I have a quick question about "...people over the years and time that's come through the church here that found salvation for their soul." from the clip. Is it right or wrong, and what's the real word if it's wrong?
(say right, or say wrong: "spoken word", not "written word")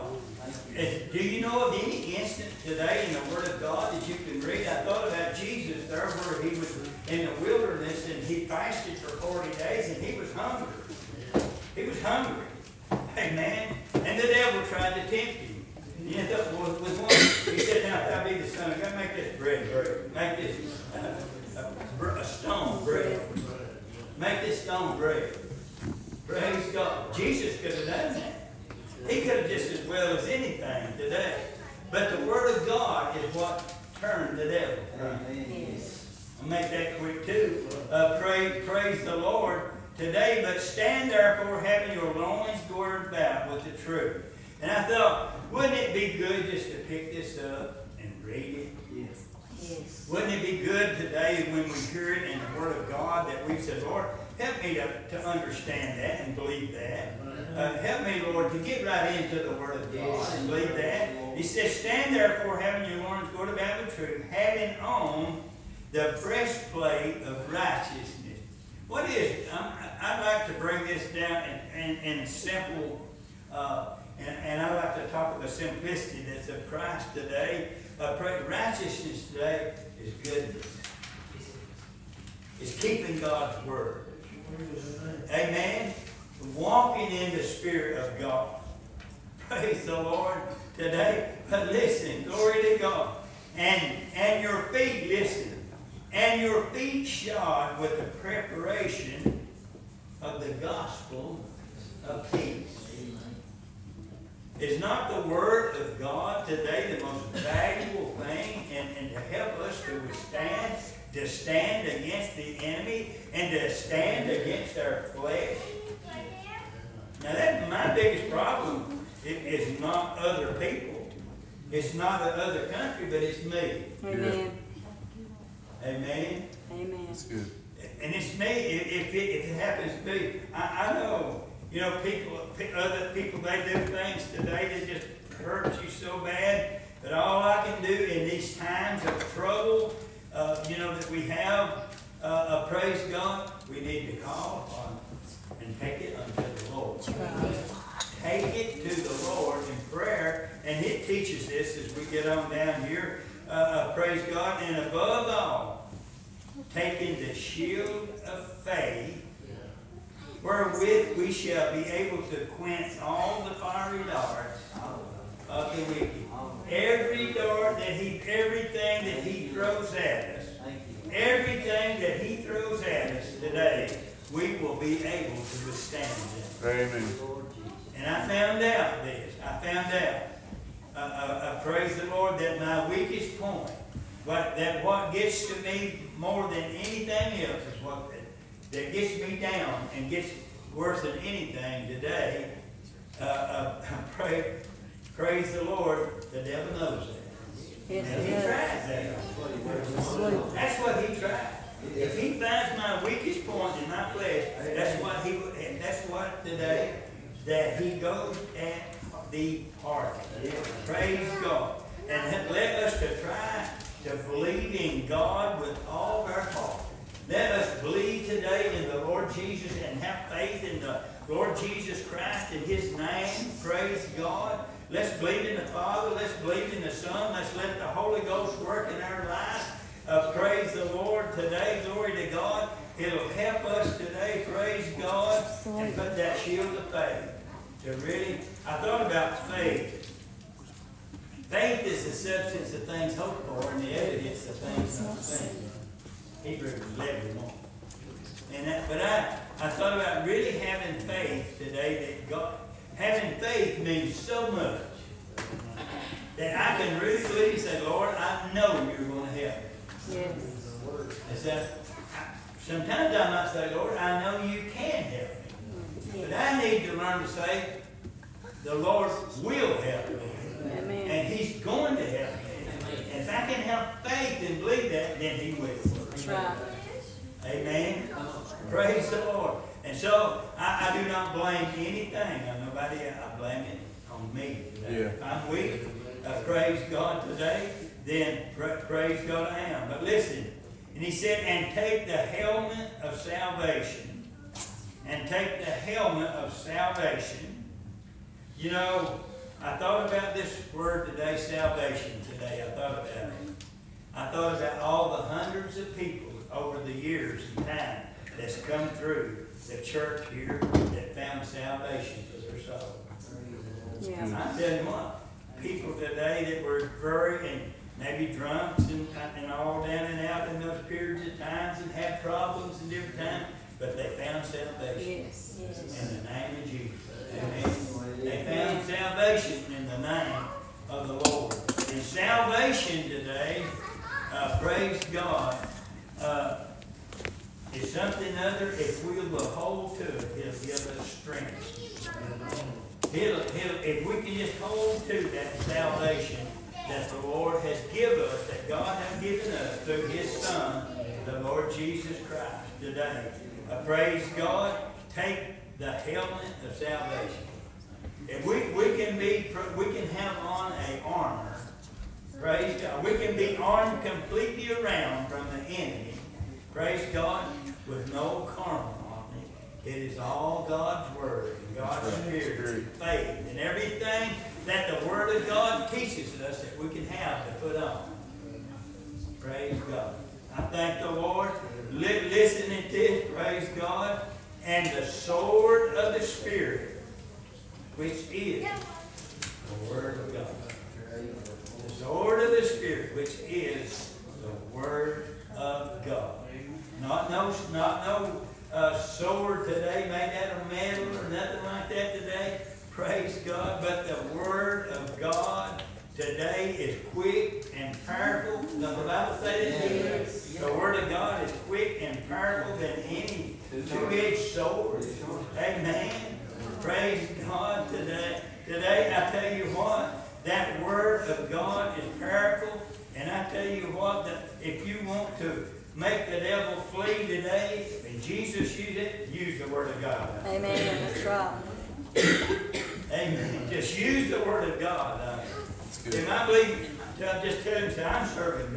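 right.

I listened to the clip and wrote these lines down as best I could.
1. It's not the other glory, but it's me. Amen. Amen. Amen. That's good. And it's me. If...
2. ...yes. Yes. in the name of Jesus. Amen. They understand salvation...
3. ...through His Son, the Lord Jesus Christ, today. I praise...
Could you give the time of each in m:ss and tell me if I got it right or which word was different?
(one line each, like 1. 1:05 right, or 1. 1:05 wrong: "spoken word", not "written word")
1. 2:01 wrong: "country", not "glory"
2. 5:25 wrong: "found", not "understand"
3. 5:49 right.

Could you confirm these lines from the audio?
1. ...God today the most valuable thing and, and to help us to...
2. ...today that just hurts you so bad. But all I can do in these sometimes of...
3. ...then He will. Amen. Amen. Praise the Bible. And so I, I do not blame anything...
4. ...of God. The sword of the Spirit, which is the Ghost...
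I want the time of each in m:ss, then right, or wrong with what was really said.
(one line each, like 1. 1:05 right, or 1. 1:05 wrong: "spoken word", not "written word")
1. 1:45 right
2. 2:14 wrong: "times", not "sometimes"
3. 4:35 wrong: "Lord", not "Bible"
4. 6:30 wrong: "Word", not "Ghost".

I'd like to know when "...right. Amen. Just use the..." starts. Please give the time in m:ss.
7:11.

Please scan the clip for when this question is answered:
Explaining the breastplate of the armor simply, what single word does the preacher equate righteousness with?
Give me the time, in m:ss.
1:20.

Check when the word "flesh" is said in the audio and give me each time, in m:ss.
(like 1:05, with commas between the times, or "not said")
1:55, 3:24.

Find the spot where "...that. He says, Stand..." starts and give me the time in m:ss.
1:00.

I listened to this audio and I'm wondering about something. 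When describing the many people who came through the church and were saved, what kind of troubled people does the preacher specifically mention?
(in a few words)
drunks.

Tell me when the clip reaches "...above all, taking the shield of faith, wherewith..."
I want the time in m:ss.
2:34.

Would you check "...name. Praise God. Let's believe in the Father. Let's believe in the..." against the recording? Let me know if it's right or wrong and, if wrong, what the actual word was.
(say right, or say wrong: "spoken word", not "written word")
right.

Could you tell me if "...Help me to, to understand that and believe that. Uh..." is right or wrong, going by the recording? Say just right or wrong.
right.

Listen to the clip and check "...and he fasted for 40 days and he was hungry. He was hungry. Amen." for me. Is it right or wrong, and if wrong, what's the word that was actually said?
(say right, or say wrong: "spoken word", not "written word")
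right.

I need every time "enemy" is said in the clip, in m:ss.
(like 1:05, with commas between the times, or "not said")
1:52, 6:05.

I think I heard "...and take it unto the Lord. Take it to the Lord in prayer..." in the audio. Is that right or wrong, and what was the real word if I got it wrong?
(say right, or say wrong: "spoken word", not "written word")
right.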